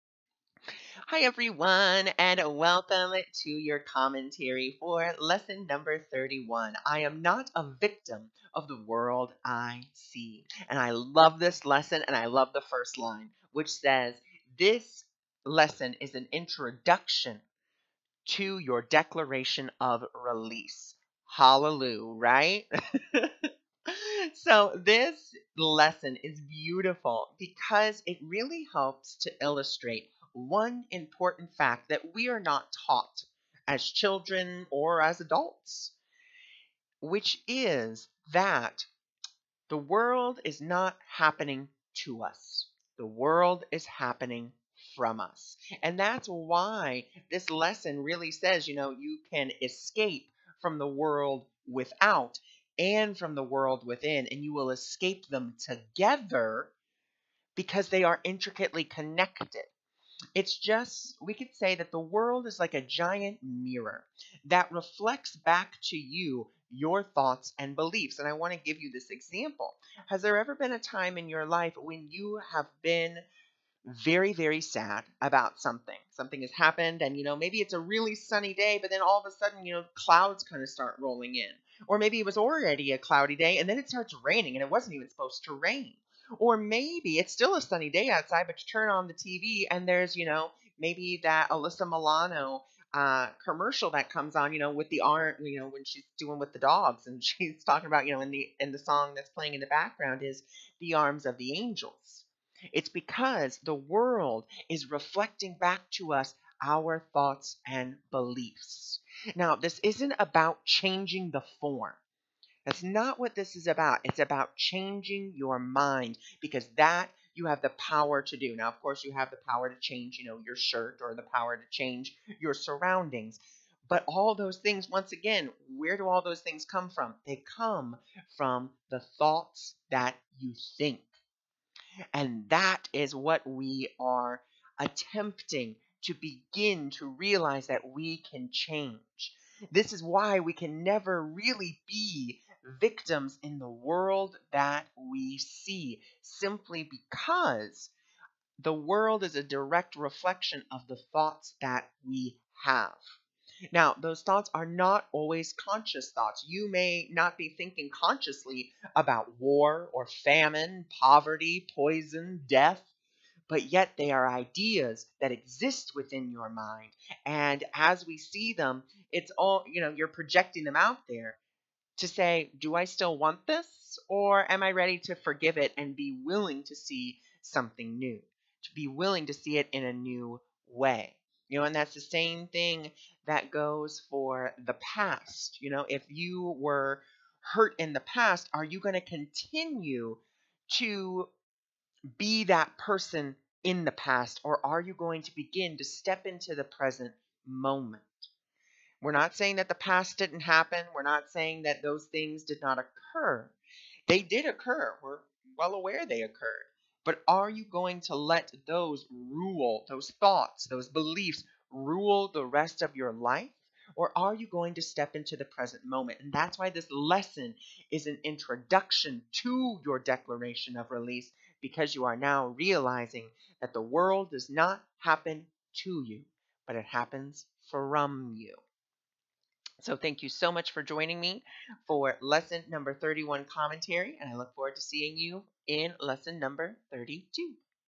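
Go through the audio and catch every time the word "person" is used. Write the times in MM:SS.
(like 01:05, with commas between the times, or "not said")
03:12.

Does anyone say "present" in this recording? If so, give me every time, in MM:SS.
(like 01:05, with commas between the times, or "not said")
03:16, 03:35.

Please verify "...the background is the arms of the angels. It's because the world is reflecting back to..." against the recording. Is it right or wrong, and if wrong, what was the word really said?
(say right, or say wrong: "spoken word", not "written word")
right.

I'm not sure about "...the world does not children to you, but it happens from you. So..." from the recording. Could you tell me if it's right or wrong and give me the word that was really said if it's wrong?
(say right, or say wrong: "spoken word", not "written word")
wrong: "happen", not "children".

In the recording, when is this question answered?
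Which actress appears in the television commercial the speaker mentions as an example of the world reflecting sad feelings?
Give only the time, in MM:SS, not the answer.
01:31.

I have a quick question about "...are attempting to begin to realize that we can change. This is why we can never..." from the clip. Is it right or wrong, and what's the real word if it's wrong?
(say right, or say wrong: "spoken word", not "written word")
right.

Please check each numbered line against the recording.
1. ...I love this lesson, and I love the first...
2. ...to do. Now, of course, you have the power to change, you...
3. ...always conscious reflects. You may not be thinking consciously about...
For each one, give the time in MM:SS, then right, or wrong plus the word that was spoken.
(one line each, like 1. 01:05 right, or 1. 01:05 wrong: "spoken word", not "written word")
1. 00:10 right
2. 01:58 right
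3. 02:35 wrong: "thoughts", not "reflects".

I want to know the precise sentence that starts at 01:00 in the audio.
It's just, we could say that the world is like a giant mirror that reflects back to you your thoughts and beliefs.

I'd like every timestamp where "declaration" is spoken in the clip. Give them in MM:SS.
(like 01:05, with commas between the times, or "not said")
00:18, 03:39.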